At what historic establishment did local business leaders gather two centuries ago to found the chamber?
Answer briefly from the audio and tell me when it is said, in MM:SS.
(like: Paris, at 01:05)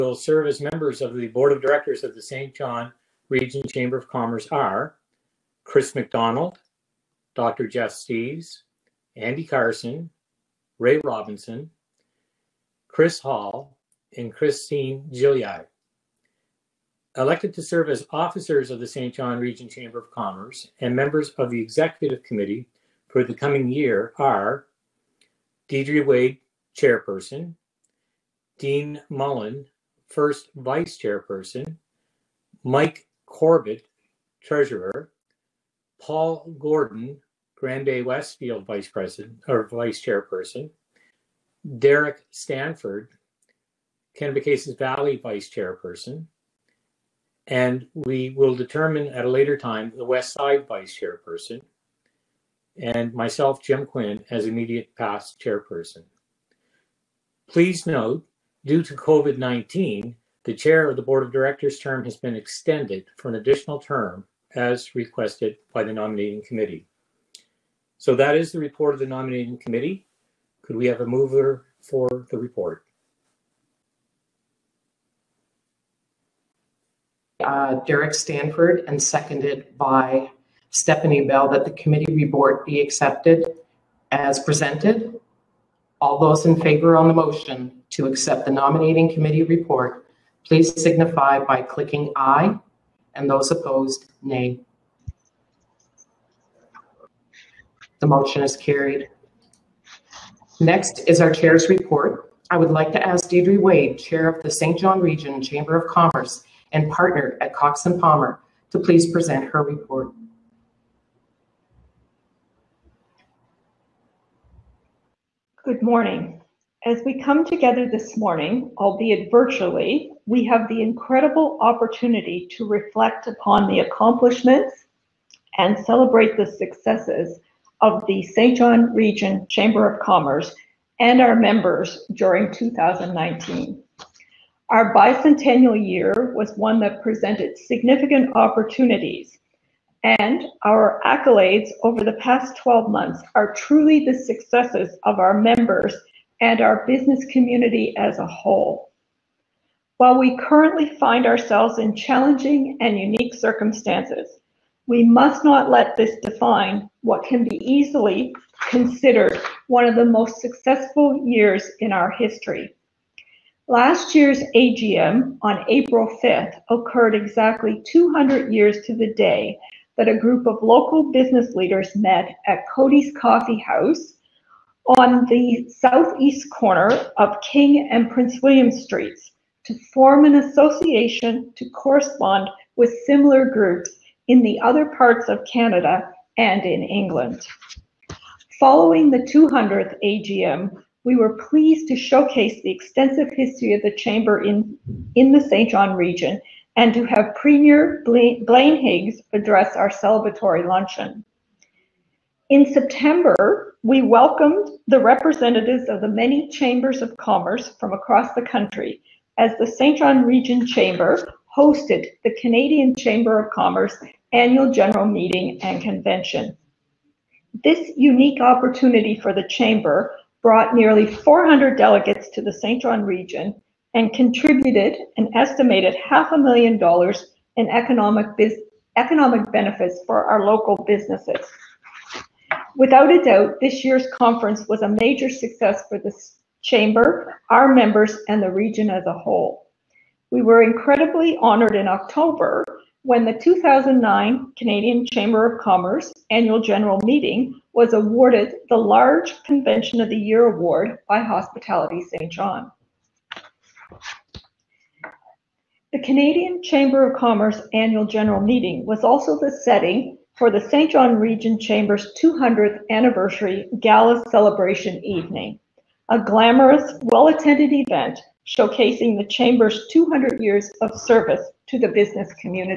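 Cody's Coffee House, at 02:52.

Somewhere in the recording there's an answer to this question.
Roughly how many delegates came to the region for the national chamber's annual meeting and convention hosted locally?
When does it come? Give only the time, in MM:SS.
03:41.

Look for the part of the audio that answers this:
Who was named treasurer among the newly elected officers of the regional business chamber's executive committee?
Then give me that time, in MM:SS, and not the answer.
00:32.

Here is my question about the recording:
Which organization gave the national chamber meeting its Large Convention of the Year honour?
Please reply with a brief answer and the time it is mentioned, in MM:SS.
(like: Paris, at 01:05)
Hospitality Saint John, at 04:11.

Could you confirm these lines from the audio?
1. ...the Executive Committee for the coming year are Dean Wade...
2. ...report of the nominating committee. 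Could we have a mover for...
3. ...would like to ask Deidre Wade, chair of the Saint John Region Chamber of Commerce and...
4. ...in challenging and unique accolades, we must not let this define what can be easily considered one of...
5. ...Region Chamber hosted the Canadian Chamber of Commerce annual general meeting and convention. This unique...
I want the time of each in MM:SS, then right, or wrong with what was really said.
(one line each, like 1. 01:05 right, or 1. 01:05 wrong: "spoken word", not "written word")
1. 00:21 wrong: "Deidre", not "Dean"
2. 01:08 right
3. 01:42 right
4. 02:31 wrong: "circumstances", not "accolades"
5. 03:30 right.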